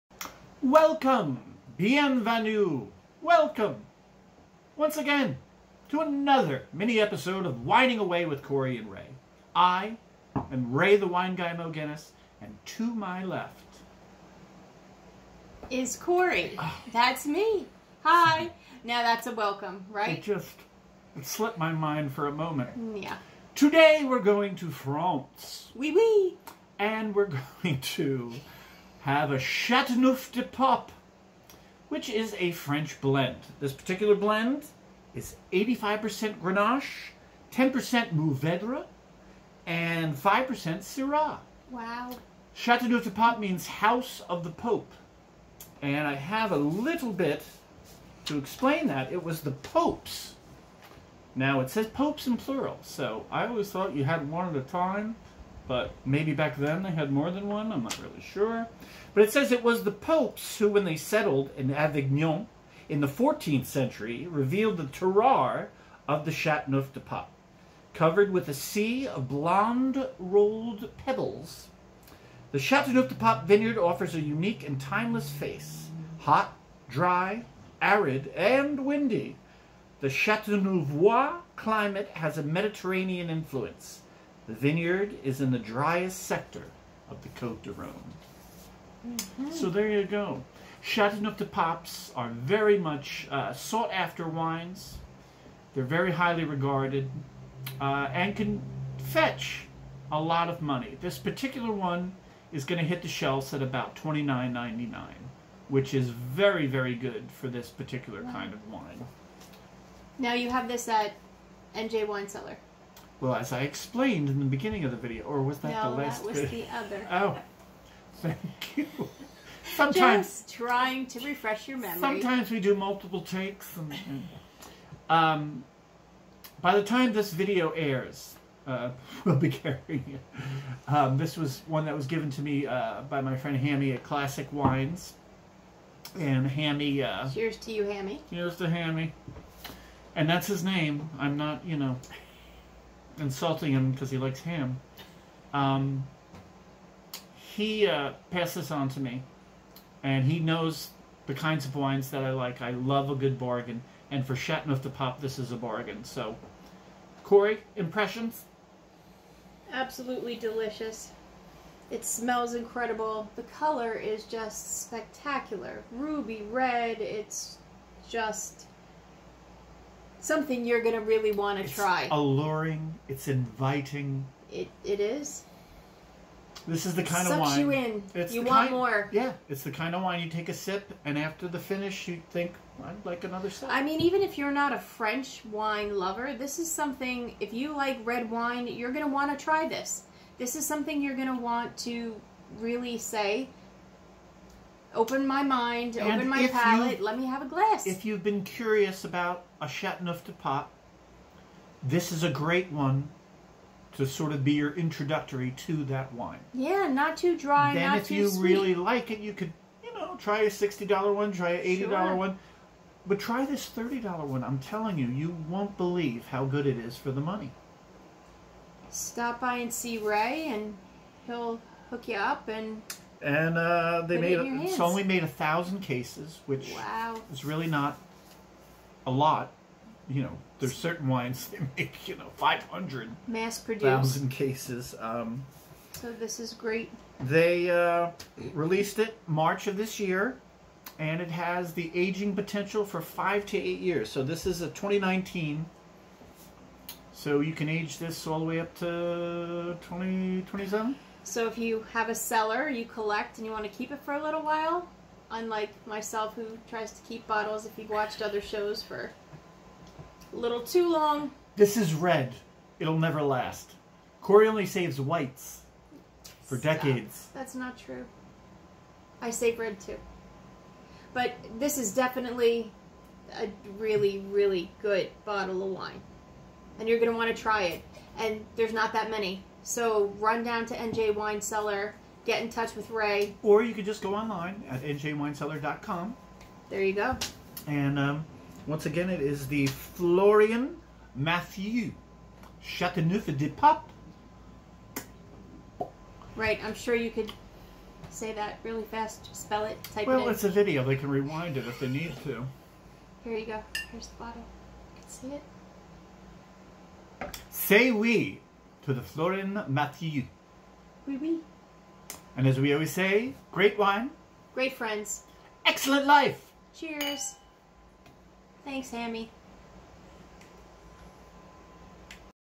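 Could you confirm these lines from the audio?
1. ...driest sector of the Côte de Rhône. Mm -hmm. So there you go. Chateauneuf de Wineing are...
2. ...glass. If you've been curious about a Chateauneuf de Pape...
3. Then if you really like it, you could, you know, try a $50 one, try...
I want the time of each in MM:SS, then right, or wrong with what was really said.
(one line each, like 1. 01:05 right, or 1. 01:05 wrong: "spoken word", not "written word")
1. 01:25 wrong: "Papes", not "Wineing"
2. 03:17 right
3. 03:28 wrong: "60", not "50".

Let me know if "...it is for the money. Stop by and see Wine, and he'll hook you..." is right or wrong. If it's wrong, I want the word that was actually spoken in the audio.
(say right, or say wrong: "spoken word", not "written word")
wrong: "Ray", not "Wine".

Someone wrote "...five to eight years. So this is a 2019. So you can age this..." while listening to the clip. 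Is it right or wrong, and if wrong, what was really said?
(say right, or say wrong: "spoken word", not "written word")
right.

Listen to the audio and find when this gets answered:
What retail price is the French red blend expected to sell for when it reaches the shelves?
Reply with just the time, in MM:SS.
01:44.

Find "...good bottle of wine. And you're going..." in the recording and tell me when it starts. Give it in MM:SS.
04:34.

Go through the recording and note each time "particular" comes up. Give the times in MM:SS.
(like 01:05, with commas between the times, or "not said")
00:33, 01:41, 01:47.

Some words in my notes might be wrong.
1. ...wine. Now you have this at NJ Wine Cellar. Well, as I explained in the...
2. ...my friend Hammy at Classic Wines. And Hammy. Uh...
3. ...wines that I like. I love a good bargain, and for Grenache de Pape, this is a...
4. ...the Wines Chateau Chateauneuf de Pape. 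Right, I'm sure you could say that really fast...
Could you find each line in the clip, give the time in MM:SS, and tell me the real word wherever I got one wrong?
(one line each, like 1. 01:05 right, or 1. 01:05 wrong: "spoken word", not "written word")
1. 01:48 right
2. 02:13 right
3. 02:31 wrong: "Chateauneuf", not "Grenache"
4. 04:49 wrong: "Florian", not "Wines".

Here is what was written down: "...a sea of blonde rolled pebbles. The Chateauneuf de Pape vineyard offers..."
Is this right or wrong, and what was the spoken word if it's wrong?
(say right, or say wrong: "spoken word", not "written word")
right.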